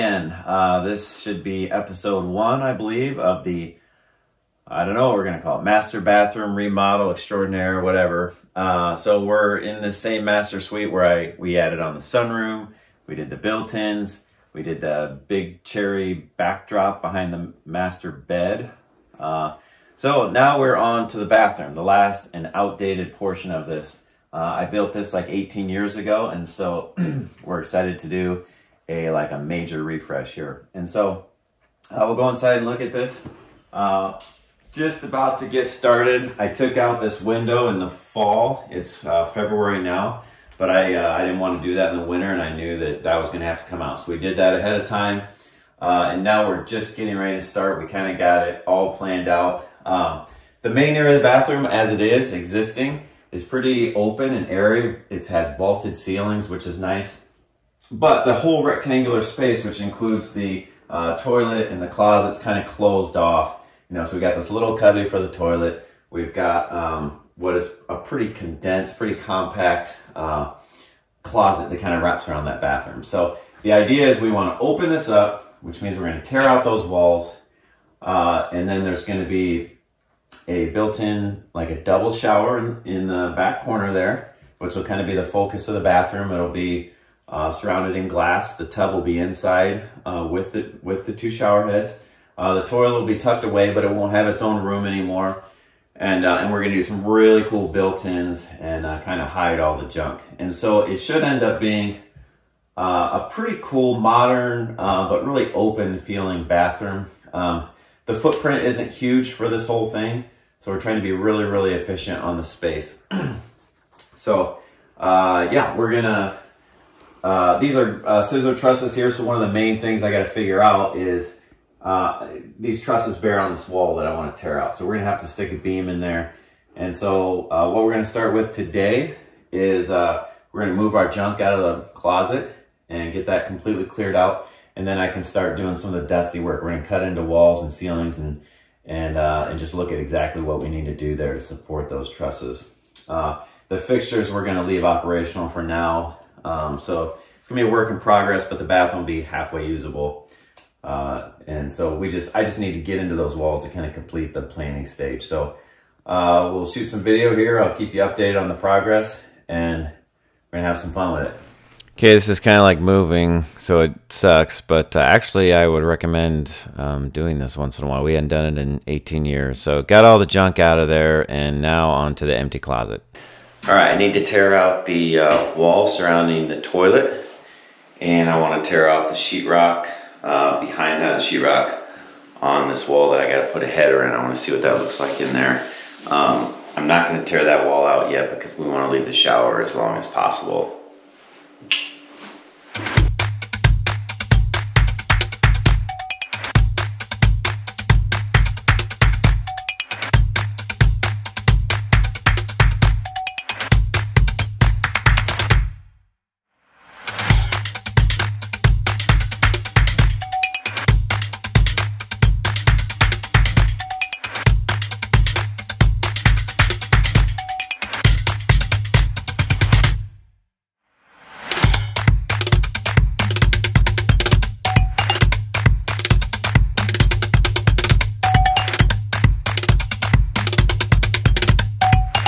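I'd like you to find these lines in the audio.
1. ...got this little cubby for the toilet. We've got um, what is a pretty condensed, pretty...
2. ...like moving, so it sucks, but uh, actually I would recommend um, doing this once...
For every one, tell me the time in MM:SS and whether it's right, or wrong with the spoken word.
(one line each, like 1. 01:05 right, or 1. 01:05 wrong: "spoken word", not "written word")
1. 01:04 right
2. 02:42 right.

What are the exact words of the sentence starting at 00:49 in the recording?
Um, the main area of the bathroom, as it is existing, is pretty open and airy.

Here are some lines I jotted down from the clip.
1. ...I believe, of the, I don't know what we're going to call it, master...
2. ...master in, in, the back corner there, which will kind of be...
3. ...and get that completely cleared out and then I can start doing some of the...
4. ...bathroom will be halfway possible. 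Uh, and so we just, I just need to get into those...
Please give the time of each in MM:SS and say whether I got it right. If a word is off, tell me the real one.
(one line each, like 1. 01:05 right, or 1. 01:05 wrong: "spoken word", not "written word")
1. 00:02 right
2. 01:22 wrong: "shower", not "master"
3. 02:12 right
4. 02:28 wrong: "usable", not "possible".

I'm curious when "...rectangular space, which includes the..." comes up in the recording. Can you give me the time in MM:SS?
00:58.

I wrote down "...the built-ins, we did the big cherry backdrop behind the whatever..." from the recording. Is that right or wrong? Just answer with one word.
wrong.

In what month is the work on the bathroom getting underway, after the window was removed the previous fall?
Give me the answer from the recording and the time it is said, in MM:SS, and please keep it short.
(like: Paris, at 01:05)
February, at 00:39.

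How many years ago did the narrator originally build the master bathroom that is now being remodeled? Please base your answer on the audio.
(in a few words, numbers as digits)
18.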